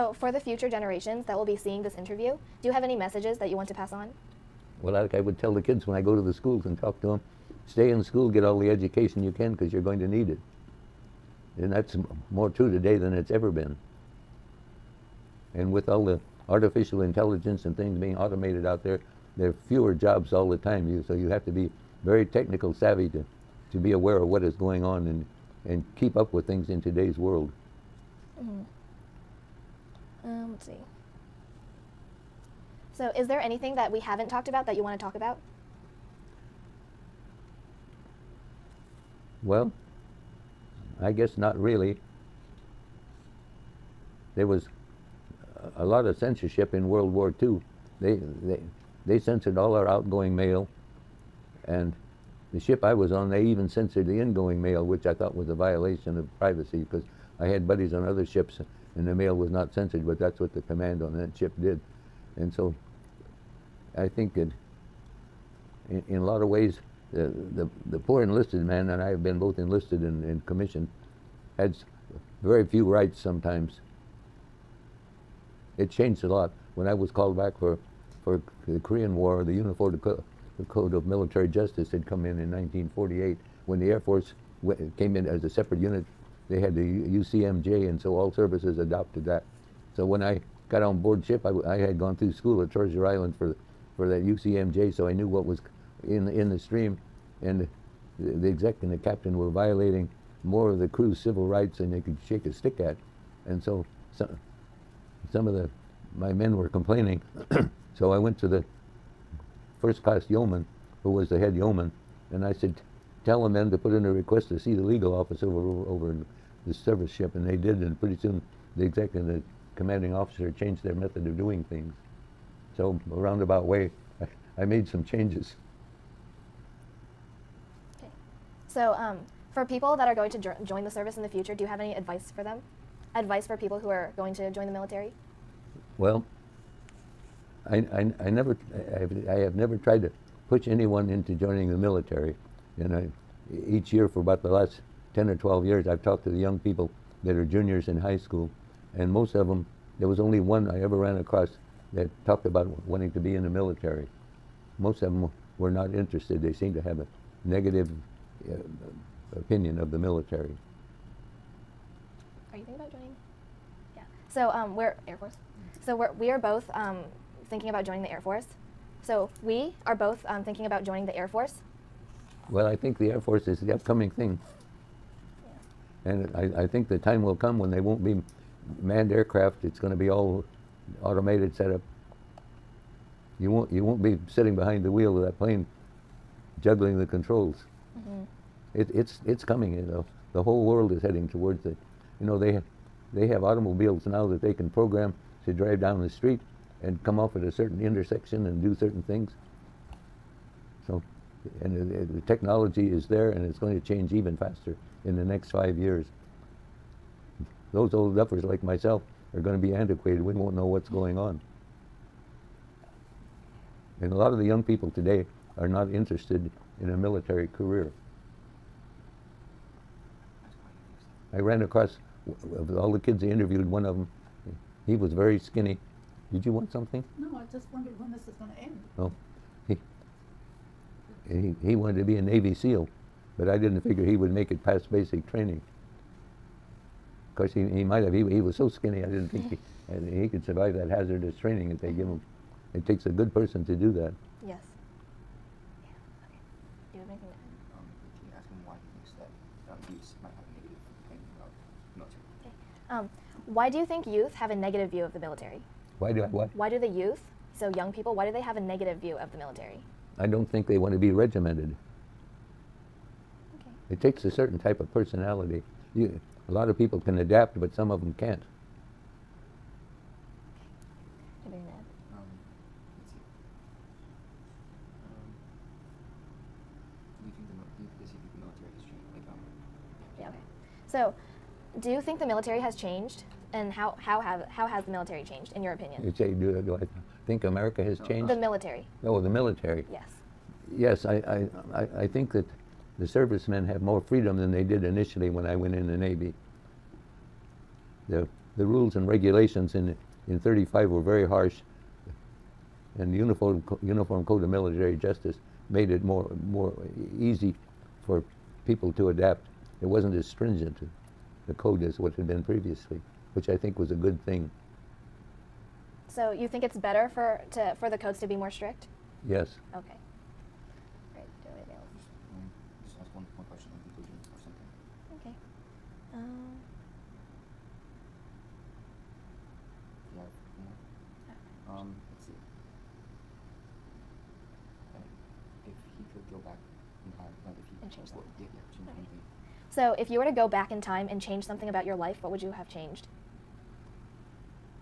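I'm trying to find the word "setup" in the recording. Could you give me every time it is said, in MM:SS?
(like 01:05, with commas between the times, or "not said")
03:01.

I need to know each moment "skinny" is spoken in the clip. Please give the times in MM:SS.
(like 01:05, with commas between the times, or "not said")
03:45, 03:58.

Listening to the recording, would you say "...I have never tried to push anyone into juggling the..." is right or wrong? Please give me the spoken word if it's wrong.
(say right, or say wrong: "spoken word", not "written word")
wrong: "joining", not "juggling".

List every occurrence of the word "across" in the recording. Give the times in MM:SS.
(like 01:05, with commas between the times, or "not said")
02:31, 03:41.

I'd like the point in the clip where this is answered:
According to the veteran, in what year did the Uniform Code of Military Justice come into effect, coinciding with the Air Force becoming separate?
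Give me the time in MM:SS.
01:22.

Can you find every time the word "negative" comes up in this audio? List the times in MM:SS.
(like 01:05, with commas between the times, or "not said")
02:37, 04:14, 04:18.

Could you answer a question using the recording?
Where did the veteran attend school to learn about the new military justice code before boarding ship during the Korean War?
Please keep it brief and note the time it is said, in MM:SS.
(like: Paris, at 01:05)
Treasure Island, at 01:32.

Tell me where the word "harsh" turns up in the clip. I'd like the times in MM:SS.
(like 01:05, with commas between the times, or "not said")
05:01.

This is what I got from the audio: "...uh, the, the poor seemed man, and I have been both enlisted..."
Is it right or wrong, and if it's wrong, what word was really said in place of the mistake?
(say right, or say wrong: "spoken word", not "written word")
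wrong: "enlisted", not "seemed".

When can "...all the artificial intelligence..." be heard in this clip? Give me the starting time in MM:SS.
00:15.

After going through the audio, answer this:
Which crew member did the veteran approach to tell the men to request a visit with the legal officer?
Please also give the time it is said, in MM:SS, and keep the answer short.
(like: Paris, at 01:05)
first class yeoman, at 01:49.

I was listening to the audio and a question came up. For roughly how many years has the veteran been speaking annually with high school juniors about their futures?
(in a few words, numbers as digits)
10 or 12 years.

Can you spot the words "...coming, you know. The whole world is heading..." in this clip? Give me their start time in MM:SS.
03:09.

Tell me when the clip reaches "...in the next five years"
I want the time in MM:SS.
03:25.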